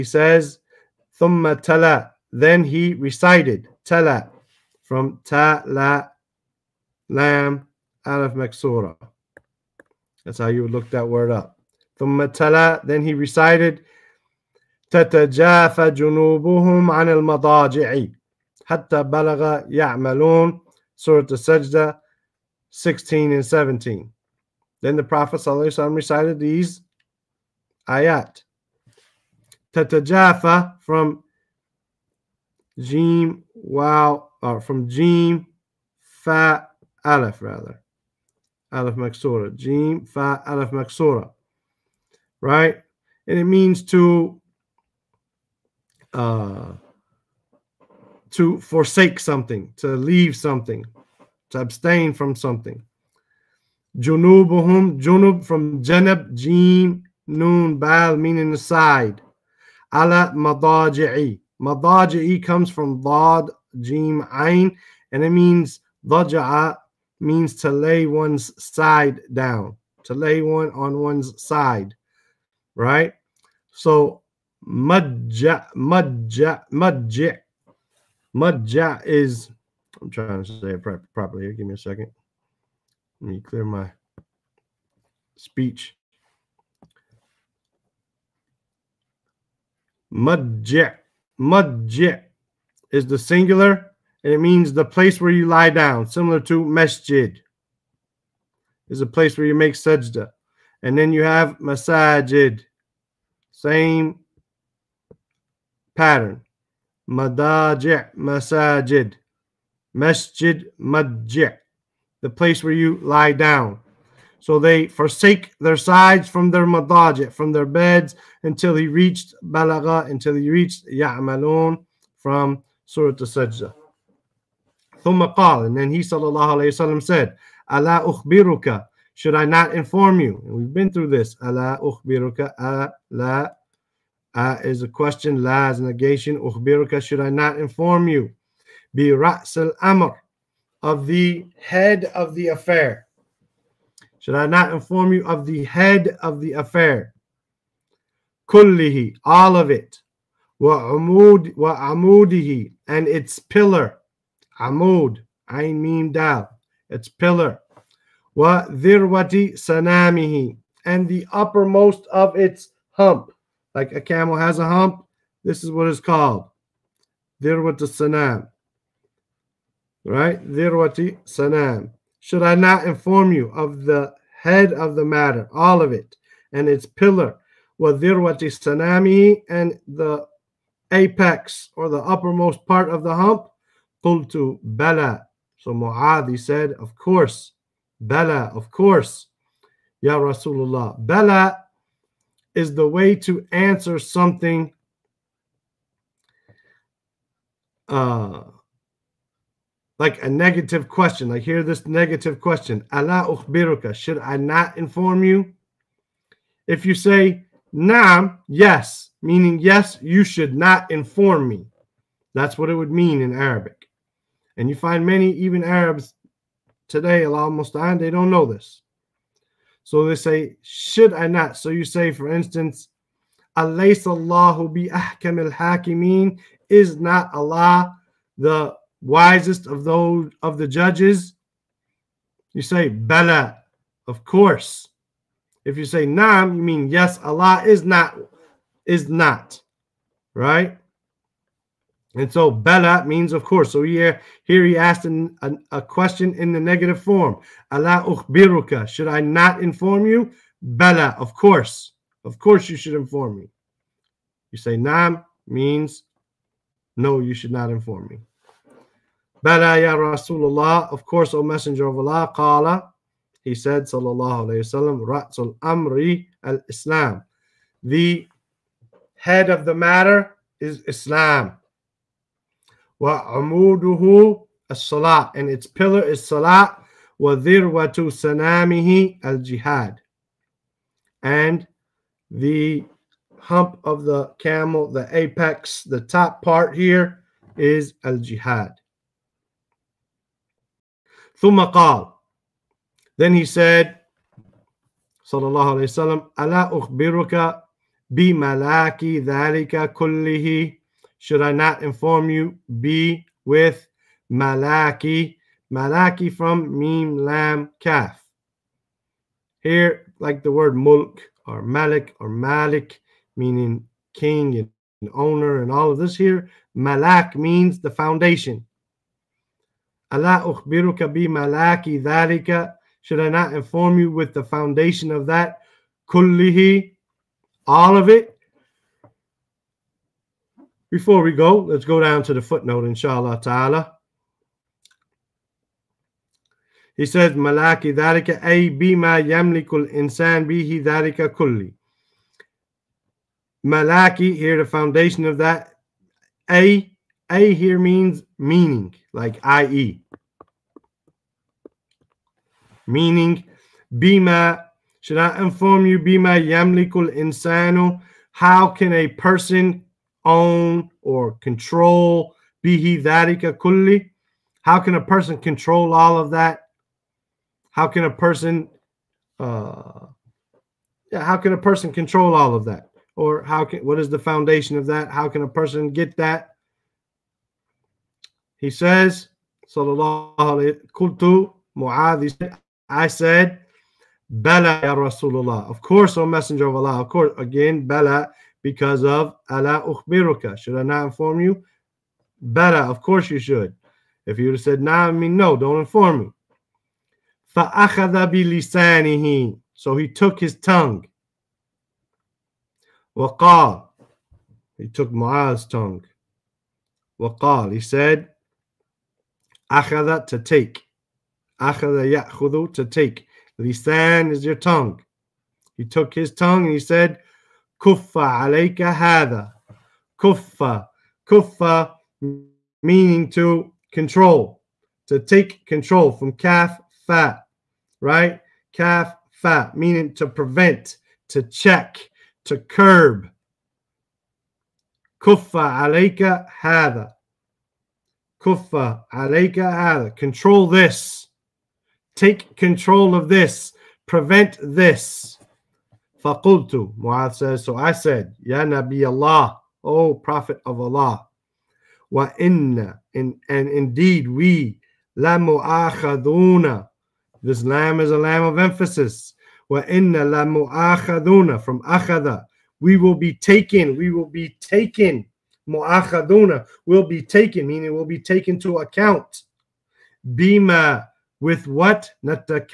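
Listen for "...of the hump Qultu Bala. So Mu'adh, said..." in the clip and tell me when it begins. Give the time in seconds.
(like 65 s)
182 s.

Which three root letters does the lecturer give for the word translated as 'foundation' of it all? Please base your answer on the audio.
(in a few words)
Mim Lam Kaf.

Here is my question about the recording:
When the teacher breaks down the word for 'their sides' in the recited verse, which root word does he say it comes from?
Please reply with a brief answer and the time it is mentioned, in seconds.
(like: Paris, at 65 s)
janab, at 55 s.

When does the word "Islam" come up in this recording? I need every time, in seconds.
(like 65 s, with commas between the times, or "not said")
266 s, 270 s.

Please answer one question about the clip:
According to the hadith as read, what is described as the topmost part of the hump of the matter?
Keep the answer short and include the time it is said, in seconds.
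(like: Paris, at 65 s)
al-jihad, at 288 s.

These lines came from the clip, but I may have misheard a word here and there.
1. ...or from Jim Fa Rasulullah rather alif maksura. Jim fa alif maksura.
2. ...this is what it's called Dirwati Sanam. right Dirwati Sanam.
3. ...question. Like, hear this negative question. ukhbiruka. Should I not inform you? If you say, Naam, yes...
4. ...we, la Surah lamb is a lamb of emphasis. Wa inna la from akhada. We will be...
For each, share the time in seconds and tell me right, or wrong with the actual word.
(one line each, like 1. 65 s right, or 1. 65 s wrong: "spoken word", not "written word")
1. 34 s wrong: "Aleph", not "Rasulullah"
2. 165 s right
3. 200 s right
4. 454 s wrong: "This", not "Surah".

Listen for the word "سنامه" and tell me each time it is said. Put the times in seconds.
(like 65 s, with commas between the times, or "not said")
159 s, 178 s, 278 s.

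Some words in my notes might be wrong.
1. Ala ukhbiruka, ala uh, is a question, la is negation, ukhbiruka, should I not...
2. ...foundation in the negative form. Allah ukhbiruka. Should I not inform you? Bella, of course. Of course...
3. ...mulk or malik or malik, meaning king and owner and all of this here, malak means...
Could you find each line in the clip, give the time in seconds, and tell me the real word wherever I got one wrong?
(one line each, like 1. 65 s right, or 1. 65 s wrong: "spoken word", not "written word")
1. 131 s right
2. 245 s wrong: "question", not "foundation"
3. 310 s right.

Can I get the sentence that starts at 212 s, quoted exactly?
That's what it would mean in Arabic.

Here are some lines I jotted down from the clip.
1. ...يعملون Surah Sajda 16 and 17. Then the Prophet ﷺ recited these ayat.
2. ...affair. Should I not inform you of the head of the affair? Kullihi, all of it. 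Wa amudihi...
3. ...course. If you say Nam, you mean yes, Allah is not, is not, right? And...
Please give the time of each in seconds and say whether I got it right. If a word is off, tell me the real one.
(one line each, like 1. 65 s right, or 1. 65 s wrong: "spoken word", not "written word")
1. 19 s right
2. 142 s right
3. 234 s right.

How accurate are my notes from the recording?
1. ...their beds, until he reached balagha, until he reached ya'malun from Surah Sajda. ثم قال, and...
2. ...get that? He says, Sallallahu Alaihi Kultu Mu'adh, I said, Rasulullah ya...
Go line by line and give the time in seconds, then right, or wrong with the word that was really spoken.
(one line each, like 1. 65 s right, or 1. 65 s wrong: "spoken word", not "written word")
1. 117 s right
2. 375 s wrong: "Bala", not "Rasulullah".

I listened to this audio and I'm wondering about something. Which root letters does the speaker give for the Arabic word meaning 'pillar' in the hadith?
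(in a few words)
Ain Mim Dal.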